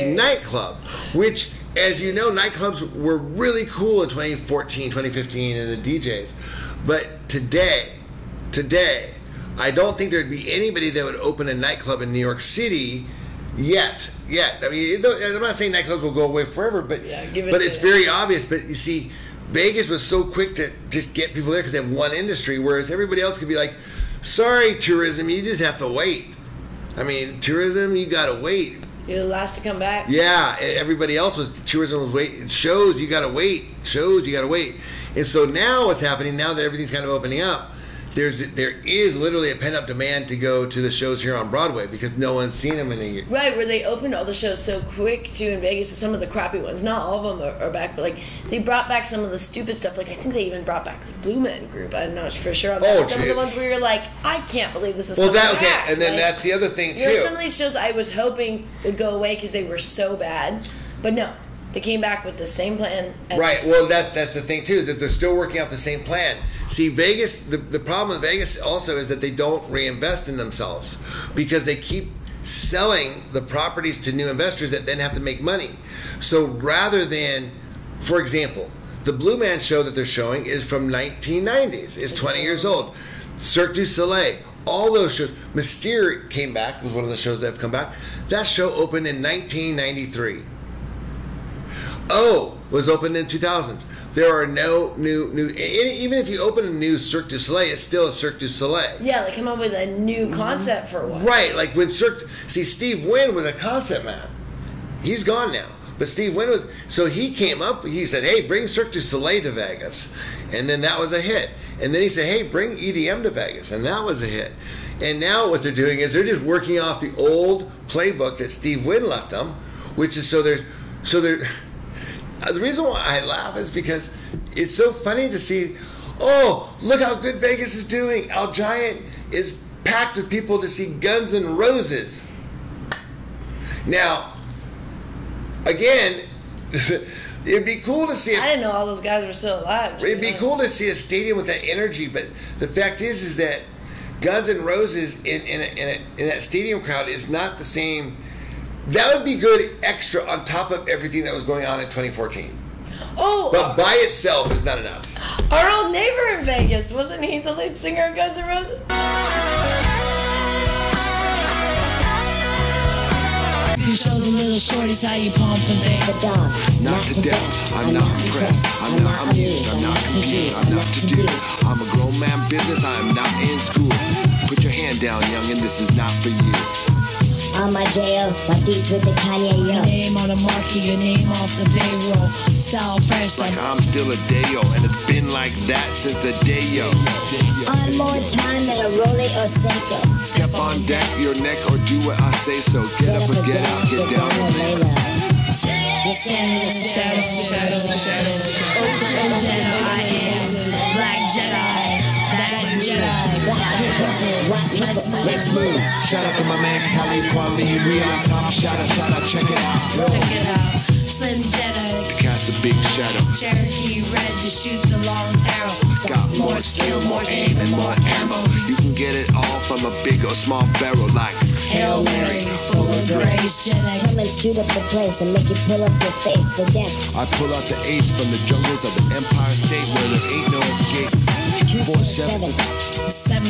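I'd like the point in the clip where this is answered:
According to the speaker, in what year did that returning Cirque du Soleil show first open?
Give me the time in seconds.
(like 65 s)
89 s.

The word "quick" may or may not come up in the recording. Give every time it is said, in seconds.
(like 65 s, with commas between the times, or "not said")
20 s, 44 s.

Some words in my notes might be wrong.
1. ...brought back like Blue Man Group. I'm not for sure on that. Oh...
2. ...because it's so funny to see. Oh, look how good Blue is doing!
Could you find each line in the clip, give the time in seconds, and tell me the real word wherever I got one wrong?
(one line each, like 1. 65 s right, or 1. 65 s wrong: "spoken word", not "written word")
1. 50 s right
2. 123 s wrong: "Vegas", not "Blue".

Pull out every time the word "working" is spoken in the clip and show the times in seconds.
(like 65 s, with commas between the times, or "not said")
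65 s, 116 s.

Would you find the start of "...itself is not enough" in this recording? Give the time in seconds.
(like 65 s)
154 s.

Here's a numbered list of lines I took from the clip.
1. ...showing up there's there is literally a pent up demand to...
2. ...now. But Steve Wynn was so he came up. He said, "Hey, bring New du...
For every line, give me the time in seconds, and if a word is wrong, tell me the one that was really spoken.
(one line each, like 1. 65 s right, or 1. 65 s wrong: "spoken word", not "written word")
1. 37 s wrong: "opening", not "showing"
2. 105 s wrong: "Cirque", not "New".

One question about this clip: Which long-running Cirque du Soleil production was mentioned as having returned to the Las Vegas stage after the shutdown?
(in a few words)
Mystere.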